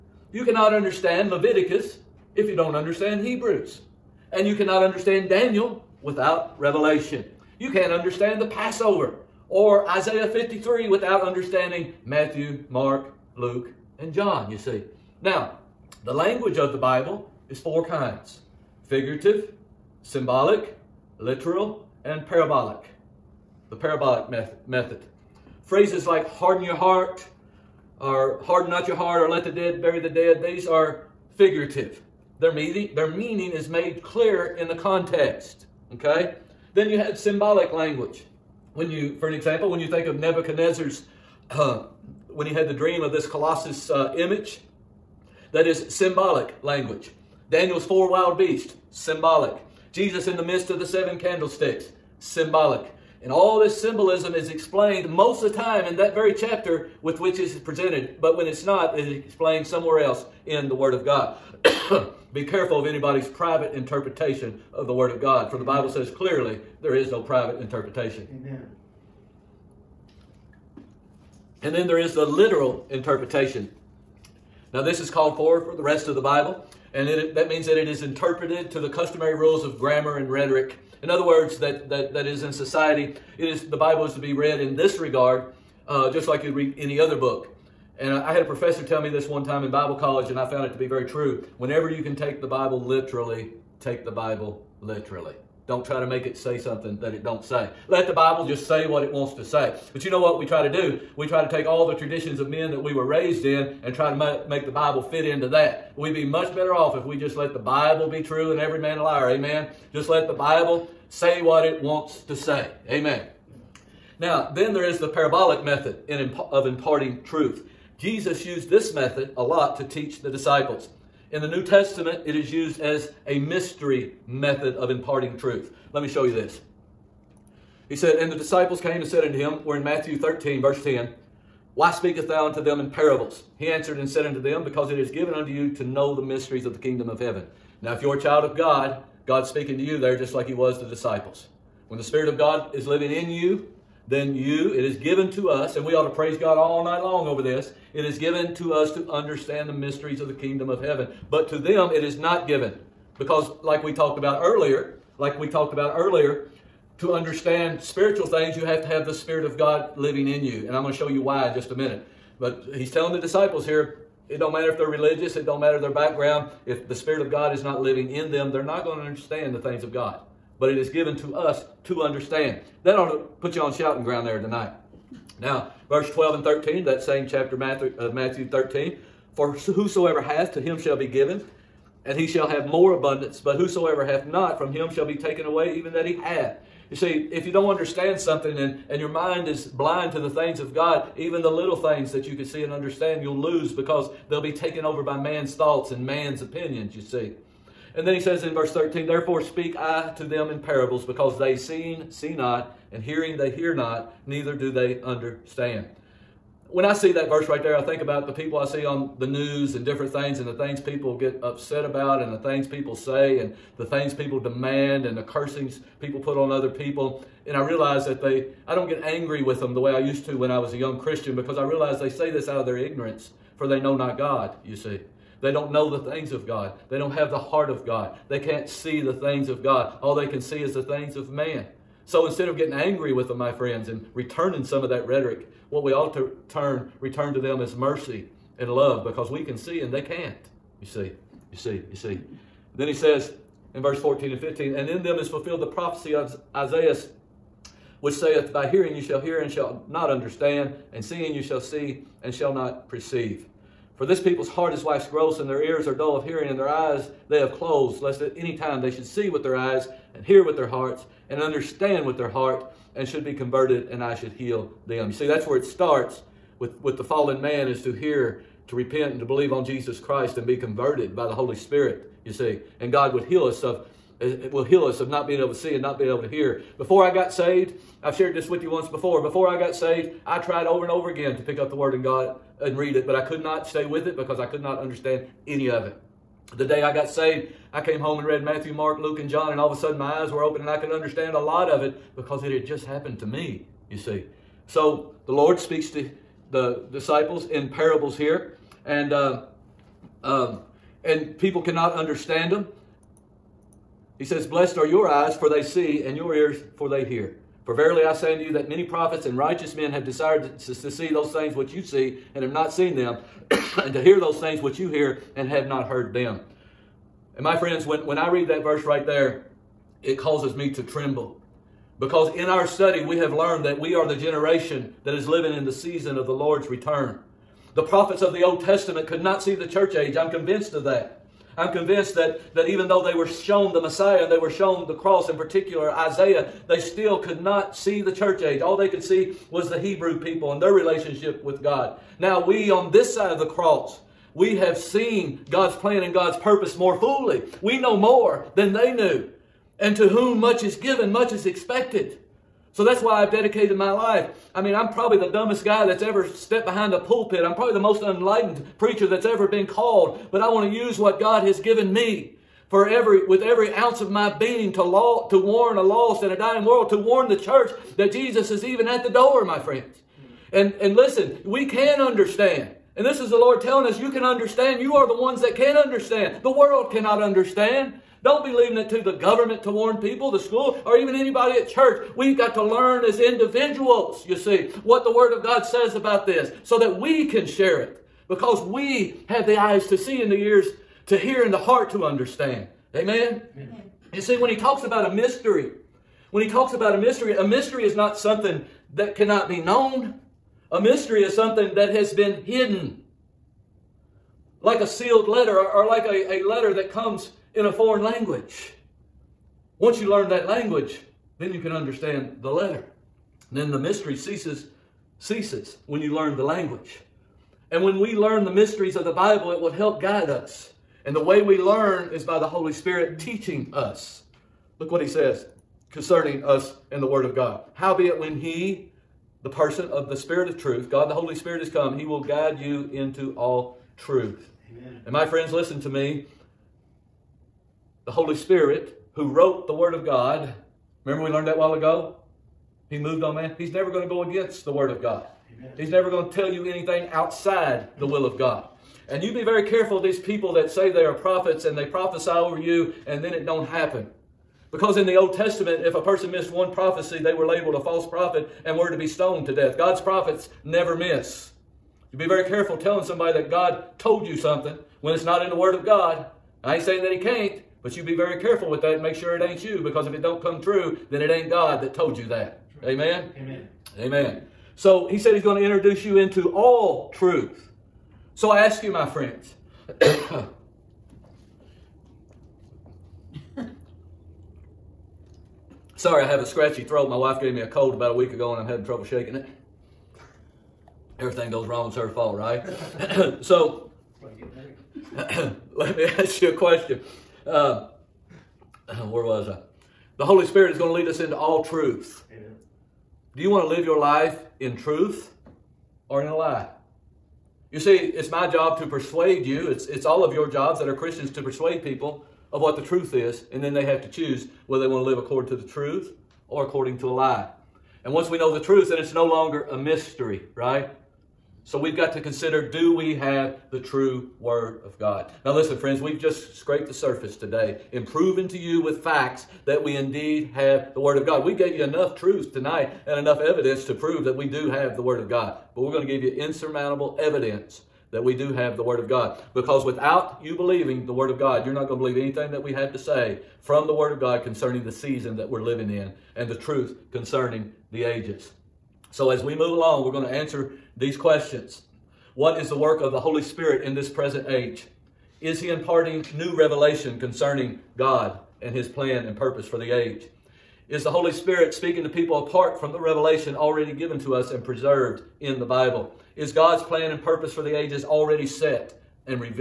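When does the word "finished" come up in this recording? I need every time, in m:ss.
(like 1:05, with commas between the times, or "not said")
not said.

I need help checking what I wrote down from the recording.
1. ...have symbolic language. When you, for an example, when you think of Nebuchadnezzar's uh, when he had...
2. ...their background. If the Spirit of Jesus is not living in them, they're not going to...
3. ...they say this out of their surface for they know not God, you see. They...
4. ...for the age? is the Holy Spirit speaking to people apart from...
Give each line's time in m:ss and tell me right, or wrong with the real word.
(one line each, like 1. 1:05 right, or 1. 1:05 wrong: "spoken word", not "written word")
1. 0:36 right
2. 2:45 wrong: "God", not "Jesus"
3. 3:41 wrong: "ignorance", not "surface"
4. 9:19 right.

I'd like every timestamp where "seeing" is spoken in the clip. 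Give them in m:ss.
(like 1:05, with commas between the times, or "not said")
3:21, 4:11.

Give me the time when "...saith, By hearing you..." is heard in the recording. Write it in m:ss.
4:08.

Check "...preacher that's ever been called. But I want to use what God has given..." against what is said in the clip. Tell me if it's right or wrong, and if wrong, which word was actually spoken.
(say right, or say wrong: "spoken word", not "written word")
right.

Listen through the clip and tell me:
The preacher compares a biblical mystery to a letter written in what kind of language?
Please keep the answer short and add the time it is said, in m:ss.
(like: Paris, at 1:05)
a foreign language, at 6:47.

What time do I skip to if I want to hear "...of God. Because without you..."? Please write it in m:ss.
8:58.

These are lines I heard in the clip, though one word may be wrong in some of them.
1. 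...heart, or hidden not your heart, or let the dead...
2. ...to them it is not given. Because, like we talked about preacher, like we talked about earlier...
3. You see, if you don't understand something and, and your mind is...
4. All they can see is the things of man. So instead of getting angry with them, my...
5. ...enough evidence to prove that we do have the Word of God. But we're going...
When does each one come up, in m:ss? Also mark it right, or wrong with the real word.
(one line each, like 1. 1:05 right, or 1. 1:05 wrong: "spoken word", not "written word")
1. 0:26 wrong: "harden", not "hidden"
2. 2:31 wrong: "earlier", not "preacher"
3. 3:06 right
4. 3:50 right
5. 8:53 right.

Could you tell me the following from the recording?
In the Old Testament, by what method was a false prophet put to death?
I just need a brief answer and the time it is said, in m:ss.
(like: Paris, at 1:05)
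stoned, at 7:39.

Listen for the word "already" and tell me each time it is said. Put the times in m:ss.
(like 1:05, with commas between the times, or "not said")
9:23, 9:28.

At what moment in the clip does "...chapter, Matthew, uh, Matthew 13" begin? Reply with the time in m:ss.
2:57.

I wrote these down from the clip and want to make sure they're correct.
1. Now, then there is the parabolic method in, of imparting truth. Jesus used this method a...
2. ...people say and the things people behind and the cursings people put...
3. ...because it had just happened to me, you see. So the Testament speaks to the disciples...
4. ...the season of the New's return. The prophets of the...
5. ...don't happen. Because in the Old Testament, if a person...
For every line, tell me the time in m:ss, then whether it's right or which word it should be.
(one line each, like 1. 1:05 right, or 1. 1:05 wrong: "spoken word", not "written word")
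1. 1:54 right
2. 3:32 wrong: "demand", not "behind"
3. 4:52 wrong: "Lord", not "Testament"
4. 5:25 wrong: "Lord", not "New"
5. 7:33 right.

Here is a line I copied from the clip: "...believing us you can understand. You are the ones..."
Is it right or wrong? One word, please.
wrong.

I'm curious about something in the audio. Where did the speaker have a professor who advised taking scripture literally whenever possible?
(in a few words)
Bible college.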